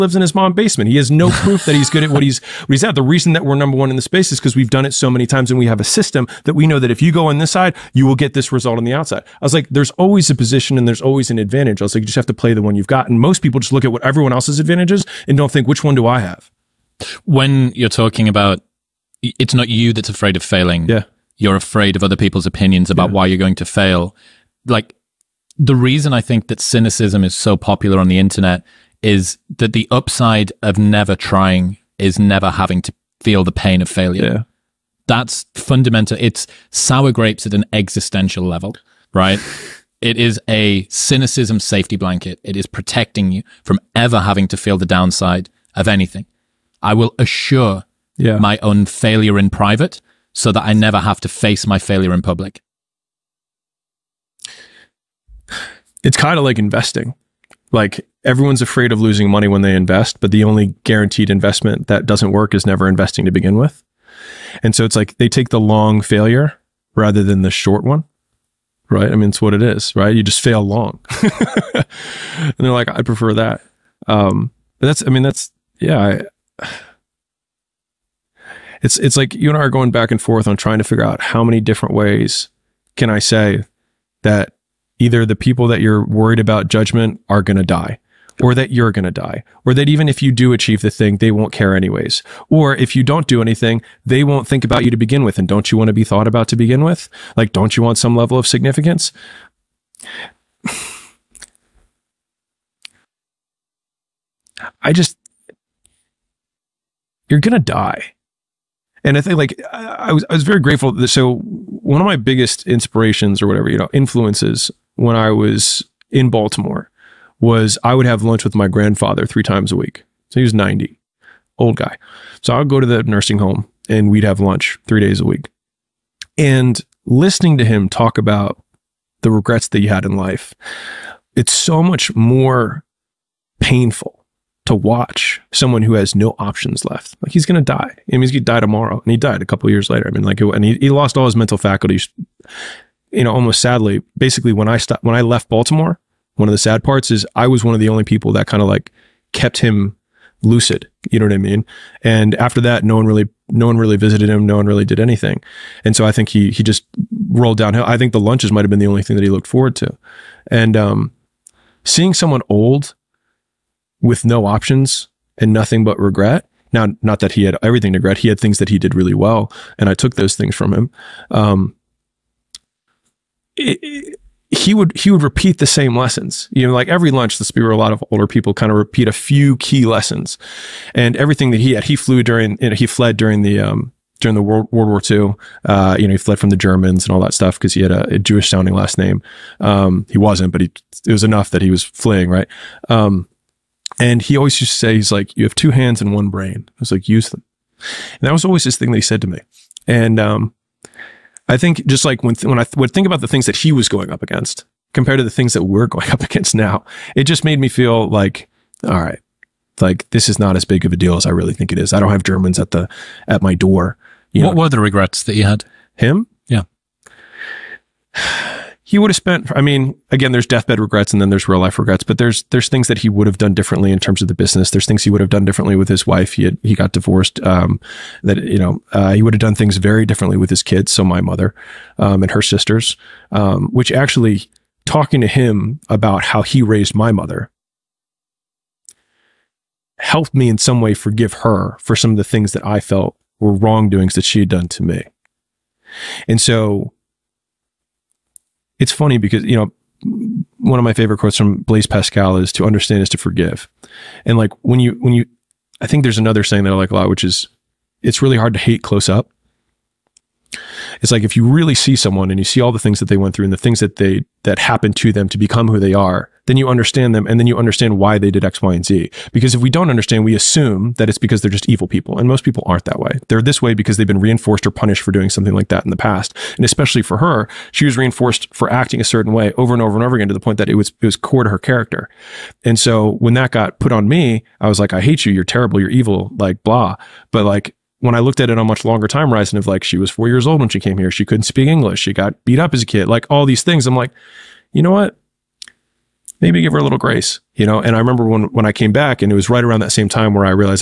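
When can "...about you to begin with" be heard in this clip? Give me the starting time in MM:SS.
01:34.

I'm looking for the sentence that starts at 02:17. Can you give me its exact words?
I mean, he's died die tomorrow.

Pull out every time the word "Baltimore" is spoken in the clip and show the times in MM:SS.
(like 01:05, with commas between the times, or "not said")
01:56, 02:25.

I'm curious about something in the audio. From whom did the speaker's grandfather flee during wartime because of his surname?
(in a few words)
The Germans.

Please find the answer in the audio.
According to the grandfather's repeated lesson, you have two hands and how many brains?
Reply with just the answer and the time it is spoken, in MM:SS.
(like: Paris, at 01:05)
1, at 03:16.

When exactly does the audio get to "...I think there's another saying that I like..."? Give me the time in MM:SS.
04:15.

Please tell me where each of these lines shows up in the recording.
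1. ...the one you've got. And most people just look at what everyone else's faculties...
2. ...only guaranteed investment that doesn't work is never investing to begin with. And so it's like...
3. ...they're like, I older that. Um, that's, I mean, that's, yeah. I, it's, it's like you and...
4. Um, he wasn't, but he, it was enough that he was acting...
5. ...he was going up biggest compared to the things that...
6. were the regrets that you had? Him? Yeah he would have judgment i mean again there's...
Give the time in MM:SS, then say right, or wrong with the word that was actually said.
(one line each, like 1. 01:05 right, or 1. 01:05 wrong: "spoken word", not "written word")
1. 00:12 wrong: "advantages", not "faculties"
2. 01:00 right
3. 01:12 wrong: "prefer", not "older"
4. 03:09 wrong: "fleeing", not "acting"
5. 03:23 wrong: "against", not "biggest"
6. 03:34 wrong: "spent", not "judgment".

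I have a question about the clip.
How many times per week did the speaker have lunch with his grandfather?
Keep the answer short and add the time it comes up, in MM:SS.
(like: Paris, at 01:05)
3, at 01:59.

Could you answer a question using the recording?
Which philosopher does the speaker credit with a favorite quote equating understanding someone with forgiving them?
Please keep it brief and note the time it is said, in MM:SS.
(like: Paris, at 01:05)
Blaise Pascal, at 04:11.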